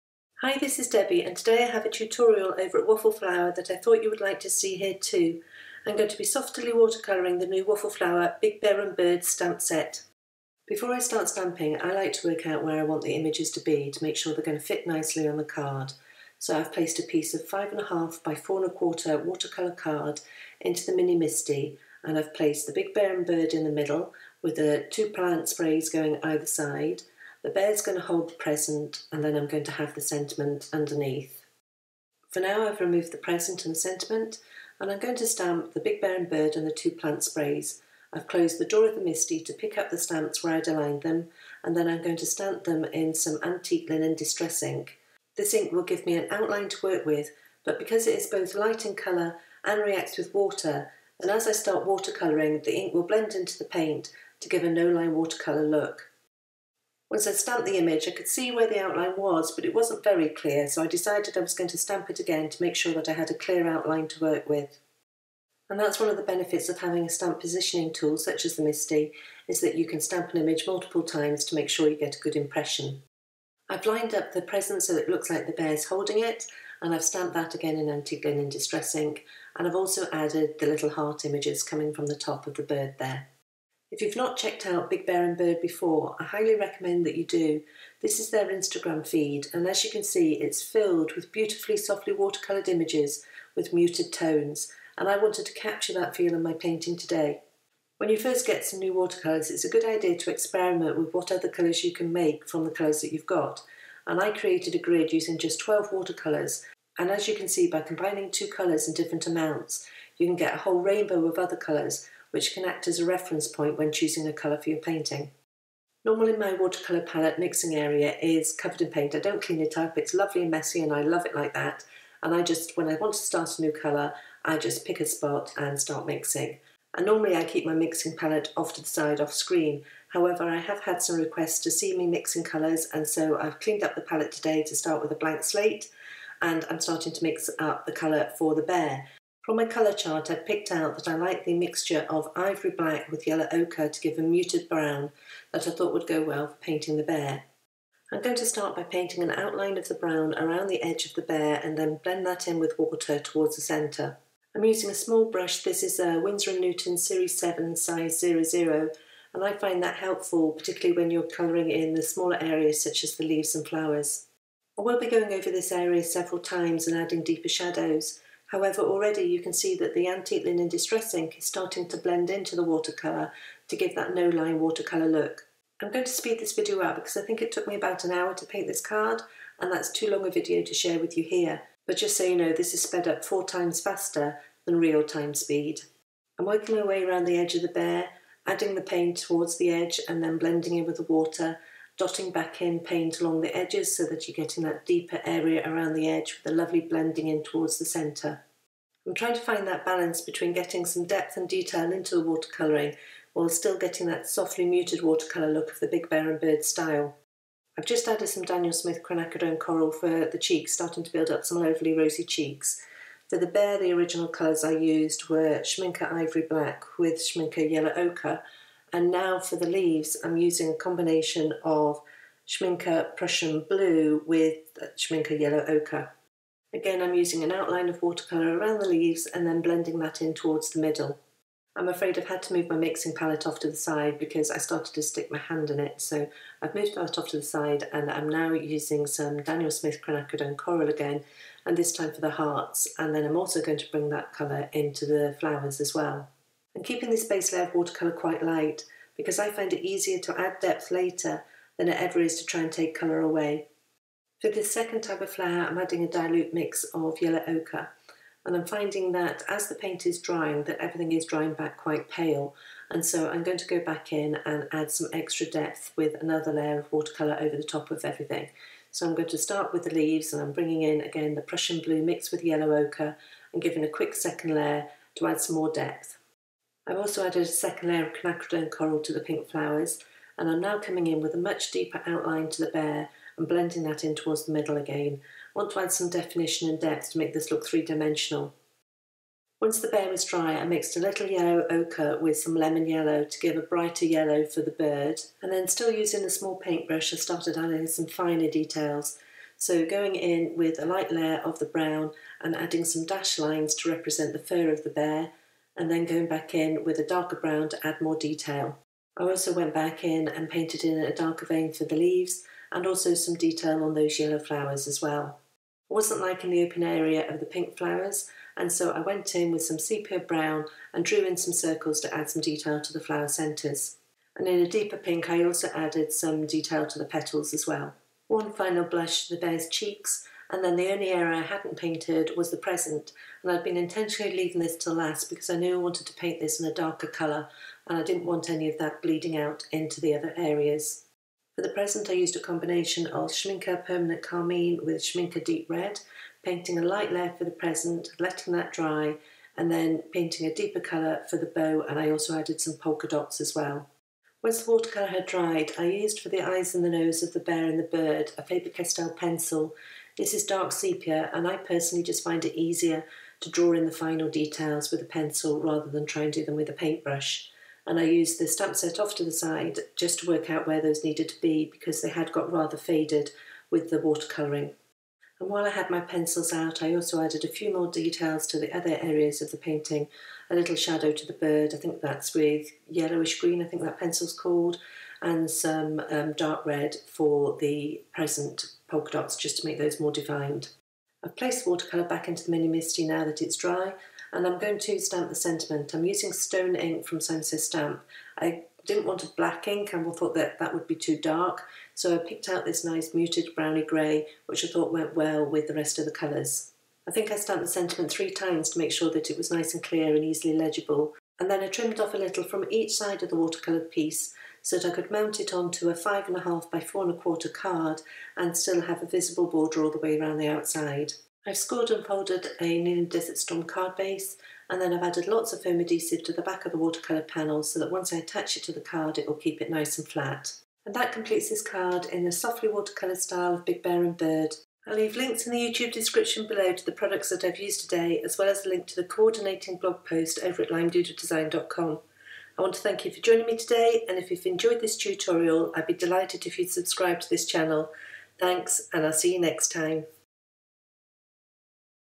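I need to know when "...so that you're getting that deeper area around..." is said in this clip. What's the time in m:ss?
3:13.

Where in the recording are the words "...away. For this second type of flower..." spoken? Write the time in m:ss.
4:13.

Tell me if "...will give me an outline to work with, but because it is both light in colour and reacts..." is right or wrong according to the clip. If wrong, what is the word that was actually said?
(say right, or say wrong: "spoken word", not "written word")
right.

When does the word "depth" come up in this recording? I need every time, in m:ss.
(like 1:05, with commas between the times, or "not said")
3:21, 4:10, 4:25, 4:35, 4:46.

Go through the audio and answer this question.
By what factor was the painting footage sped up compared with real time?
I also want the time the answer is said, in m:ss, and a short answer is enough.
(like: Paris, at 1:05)
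4 times, at 3:03.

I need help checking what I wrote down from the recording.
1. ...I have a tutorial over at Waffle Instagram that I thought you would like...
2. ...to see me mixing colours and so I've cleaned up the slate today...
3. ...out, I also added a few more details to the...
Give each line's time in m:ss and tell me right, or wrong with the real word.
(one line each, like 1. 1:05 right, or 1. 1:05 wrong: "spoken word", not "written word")
1. 0:01 wrong: "Flower", not "Instagram"
2. 2:11 wrong: "palette", not "slate"
3. 6:16 right.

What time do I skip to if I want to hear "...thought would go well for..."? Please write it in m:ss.
2:25.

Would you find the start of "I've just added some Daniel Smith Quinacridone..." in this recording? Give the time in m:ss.
3:27.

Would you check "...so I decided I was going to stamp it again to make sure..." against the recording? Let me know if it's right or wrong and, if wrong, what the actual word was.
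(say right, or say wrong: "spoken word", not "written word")
right.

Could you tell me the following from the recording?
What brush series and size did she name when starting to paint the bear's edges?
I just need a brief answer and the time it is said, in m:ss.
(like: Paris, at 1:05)
Series 7 size 00, at 2:36.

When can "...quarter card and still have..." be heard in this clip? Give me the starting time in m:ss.
6:57.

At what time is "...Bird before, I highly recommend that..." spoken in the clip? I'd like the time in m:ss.
1:25.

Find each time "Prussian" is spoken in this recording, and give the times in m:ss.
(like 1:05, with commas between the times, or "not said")
3:43, 4:31.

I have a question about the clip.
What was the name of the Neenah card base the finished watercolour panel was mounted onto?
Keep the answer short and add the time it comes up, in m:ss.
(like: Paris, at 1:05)
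Desert Storm, at 7:03.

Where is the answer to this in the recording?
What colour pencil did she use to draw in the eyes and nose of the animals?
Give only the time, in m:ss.
6:00.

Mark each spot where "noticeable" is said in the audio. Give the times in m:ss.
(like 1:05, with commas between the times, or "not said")
not said.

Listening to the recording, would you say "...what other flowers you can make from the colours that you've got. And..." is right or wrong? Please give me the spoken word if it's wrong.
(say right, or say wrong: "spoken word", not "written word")
wrong: "colours", not "flowers".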